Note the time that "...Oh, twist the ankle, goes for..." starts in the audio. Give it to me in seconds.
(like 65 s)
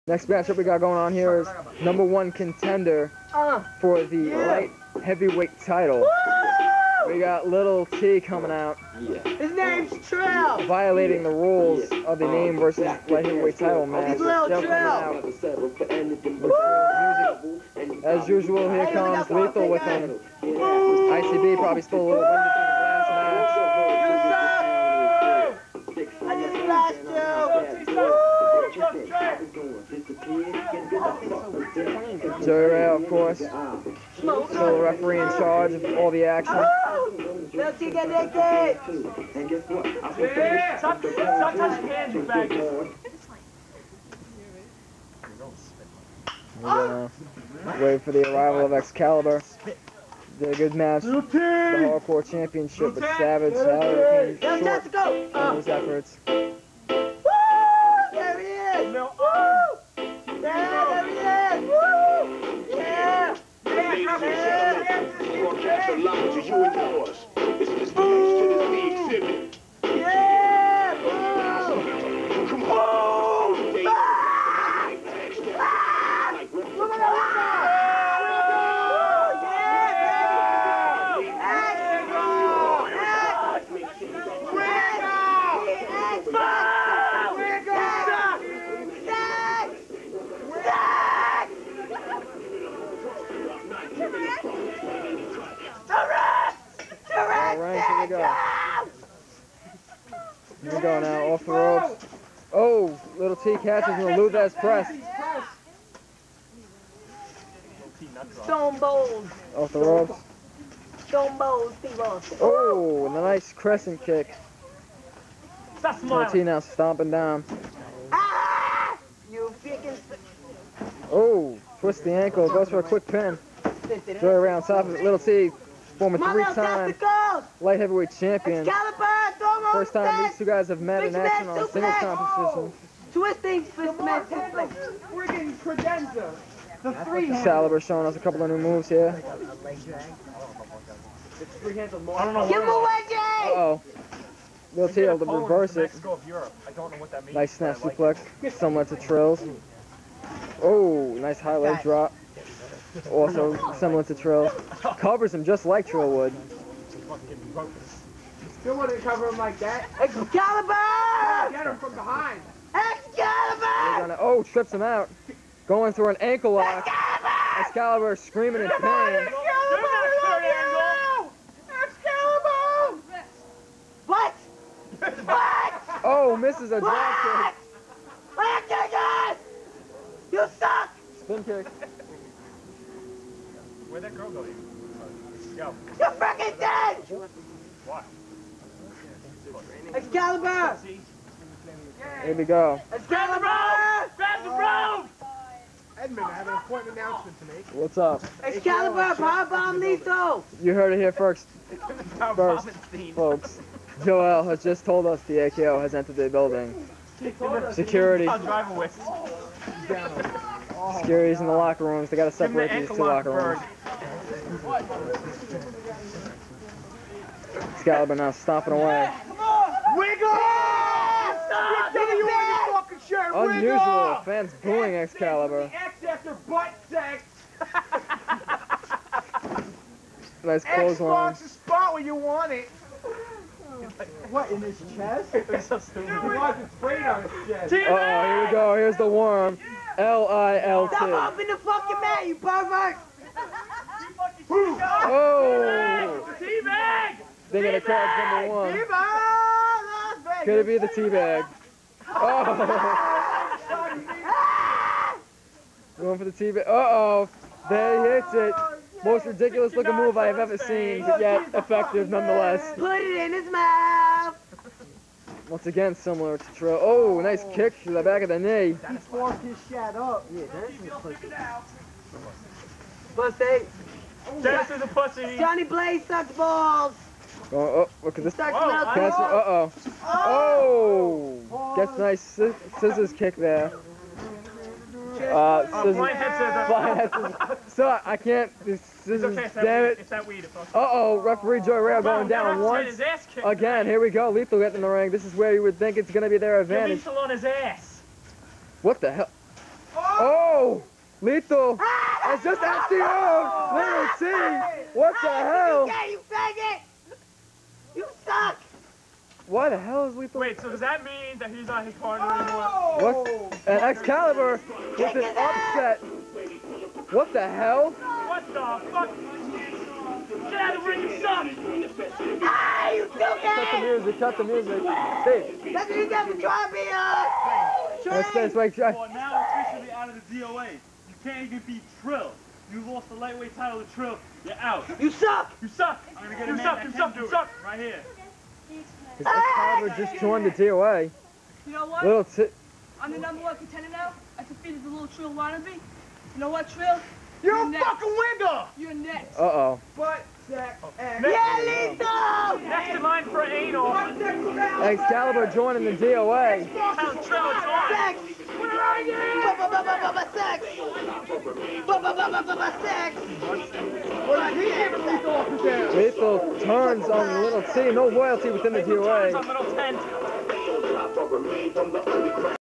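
121 s.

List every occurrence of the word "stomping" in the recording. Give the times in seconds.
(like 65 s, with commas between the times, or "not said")
116 s, 218 s.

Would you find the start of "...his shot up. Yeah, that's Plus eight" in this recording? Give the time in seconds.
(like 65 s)
269 s.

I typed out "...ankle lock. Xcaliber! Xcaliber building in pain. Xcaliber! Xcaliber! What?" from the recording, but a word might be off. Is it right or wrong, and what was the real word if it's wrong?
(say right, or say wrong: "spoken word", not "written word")
wrong: "screaming", not "building".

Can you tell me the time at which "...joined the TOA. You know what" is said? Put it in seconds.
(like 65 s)
340 s.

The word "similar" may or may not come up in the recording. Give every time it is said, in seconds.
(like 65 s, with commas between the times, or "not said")
148 s, 153 s, 265 s.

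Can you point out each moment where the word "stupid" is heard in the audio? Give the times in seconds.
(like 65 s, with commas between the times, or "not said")
235 s, 323 s.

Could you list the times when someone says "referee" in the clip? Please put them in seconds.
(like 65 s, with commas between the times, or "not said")
34 s, 291 s.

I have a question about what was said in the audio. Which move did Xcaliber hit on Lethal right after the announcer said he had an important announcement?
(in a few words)
Power Bomb.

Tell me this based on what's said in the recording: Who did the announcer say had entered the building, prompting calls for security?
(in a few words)
AKO.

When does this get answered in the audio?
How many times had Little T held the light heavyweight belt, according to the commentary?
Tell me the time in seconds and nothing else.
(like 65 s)
126 s.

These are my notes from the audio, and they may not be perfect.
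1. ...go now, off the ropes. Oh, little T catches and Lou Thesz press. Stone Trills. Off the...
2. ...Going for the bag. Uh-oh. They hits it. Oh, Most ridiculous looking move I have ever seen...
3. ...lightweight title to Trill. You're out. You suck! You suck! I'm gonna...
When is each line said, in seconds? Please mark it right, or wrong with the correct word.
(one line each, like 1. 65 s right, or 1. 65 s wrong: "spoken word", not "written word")
1. 100 s wrong: "Cold", not "Trills"
2. 255 s right
3. 333 s right.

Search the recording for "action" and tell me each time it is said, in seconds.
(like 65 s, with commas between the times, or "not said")
36 s, 131 s.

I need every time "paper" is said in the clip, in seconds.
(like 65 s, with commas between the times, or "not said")
not said.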